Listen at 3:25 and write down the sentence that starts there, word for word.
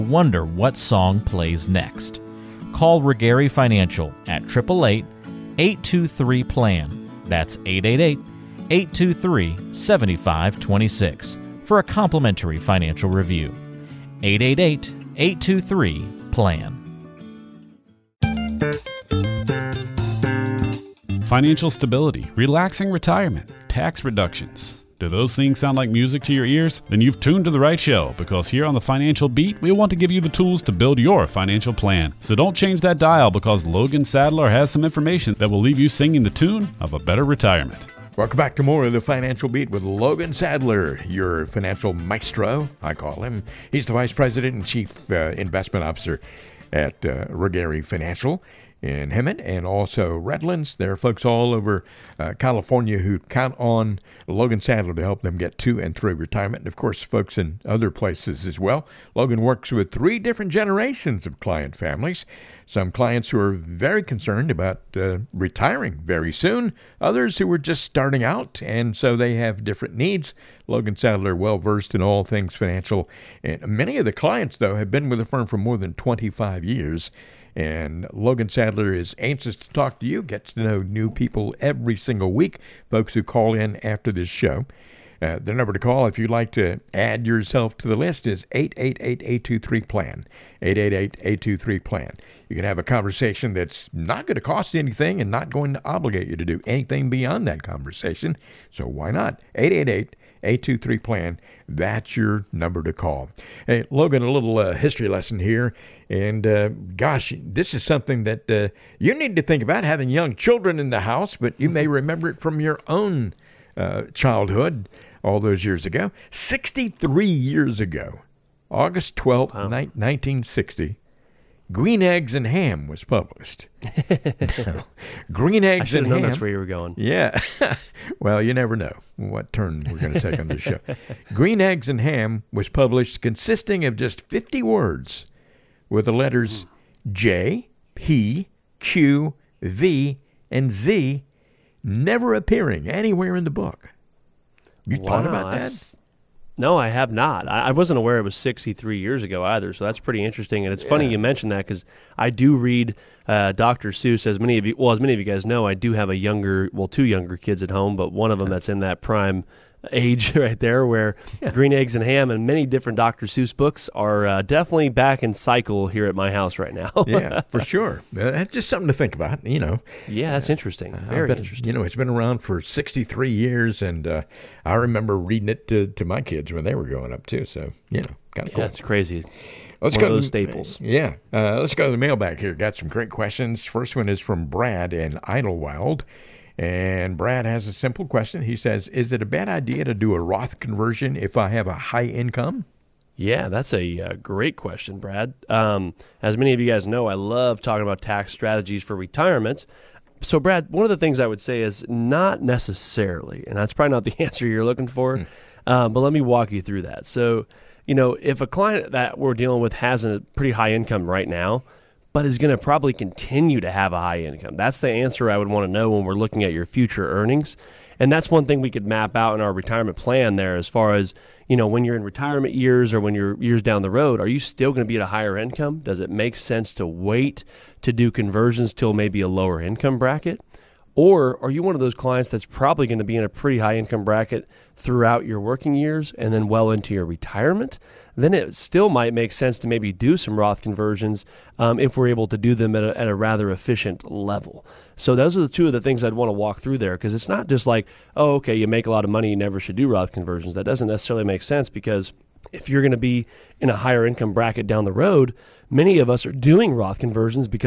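um, but let me walk you through that.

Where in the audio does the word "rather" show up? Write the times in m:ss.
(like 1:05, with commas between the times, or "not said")
4:03.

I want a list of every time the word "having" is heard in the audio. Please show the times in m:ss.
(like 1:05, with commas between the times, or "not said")
1:49.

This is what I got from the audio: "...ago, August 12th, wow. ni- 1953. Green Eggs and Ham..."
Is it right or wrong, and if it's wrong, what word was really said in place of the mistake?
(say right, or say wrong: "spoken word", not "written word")
wrong: "1960", not "1953".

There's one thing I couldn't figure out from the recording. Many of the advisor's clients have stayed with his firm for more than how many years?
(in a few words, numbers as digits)
25.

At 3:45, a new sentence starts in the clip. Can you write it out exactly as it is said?
Does it make sense to wait to do conversions till maybe a lower income bracket?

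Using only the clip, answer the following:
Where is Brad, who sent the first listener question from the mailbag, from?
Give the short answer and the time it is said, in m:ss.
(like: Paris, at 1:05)
Idyllwild, at 3:05.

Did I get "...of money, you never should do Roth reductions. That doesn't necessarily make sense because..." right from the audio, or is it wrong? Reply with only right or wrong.
wrong.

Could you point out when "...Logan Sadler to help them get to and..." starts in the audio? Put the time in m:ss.
0:54.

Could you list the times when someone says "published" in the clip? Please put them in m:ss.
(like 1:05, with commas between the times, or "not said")
2:03, 2:12.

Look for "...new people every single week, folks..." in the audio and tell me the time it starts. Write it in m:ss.
1:20.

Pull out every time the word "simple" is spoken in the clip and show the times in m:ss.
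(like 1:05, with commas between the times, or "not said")
3:07.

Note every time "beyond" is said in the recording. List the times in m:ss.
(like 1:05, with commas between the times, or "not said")
1:37.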